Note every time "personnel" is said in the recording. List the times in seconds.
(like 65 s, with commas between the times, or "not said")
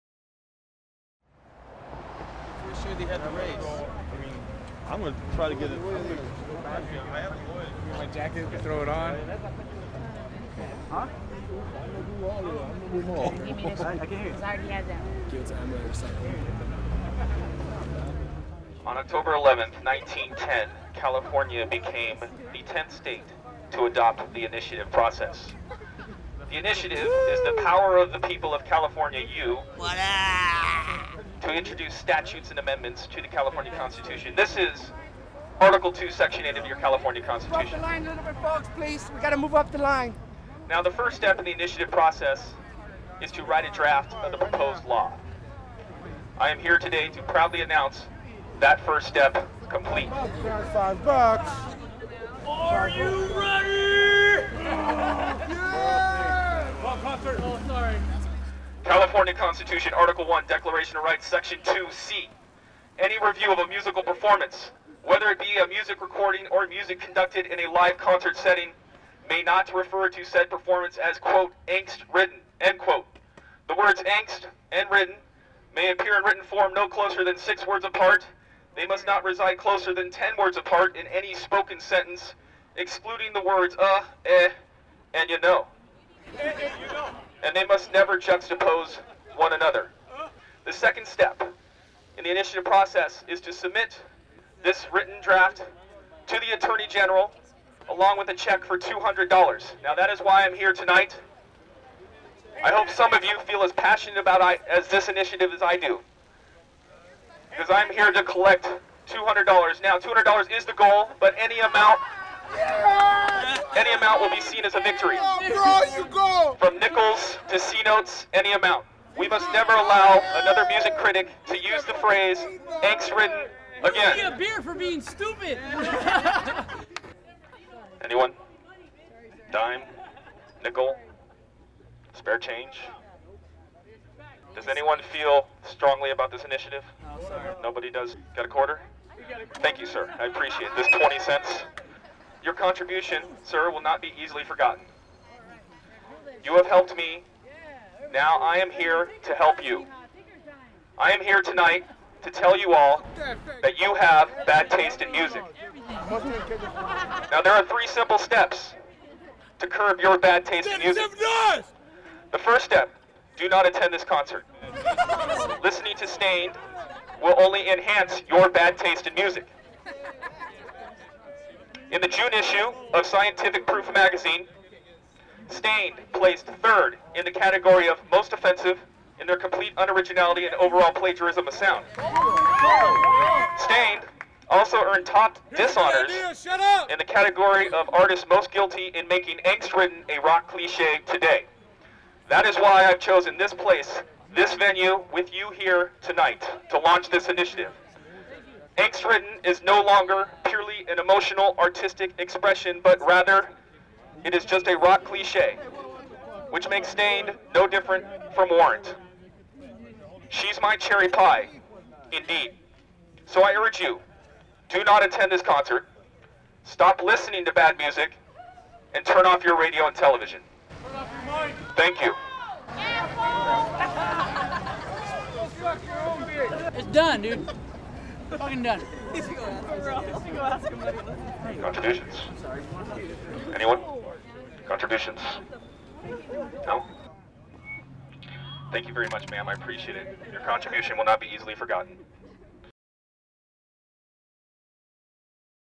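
not said.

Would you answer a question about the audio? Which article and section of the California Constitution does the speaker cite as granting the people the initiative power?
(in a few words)
Article 2, Section 8.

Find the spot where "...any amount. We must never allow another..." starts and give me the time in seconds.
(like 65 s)
118 s.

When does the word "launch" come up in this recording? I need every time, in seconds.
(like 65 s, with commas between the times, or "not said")
196 s.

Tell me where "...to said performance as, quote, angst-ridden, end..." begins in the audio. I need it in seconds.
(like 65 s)
70 s.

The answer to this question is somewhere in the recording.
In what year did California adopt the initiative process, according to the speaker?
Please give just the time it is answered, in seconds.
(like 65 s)
19 s.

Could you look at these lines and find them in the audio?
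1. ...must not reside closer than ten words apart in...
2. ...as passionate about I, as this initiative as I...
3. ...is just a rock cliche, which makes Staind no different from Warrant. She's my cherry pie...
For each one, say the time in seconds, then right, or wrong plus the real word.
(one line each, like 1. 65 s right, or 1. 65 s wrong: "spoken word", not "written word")
1. 78 s right
2. 103 s right
3. 204 s right.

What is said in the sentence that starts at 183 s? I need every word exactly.
Staind also earned top dishonors in the category of artist most guilty in making angst-ridden a rock cliche today.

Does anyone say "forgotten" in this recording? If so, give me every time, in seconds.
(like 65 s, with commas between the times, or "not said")
144 s, 241 s.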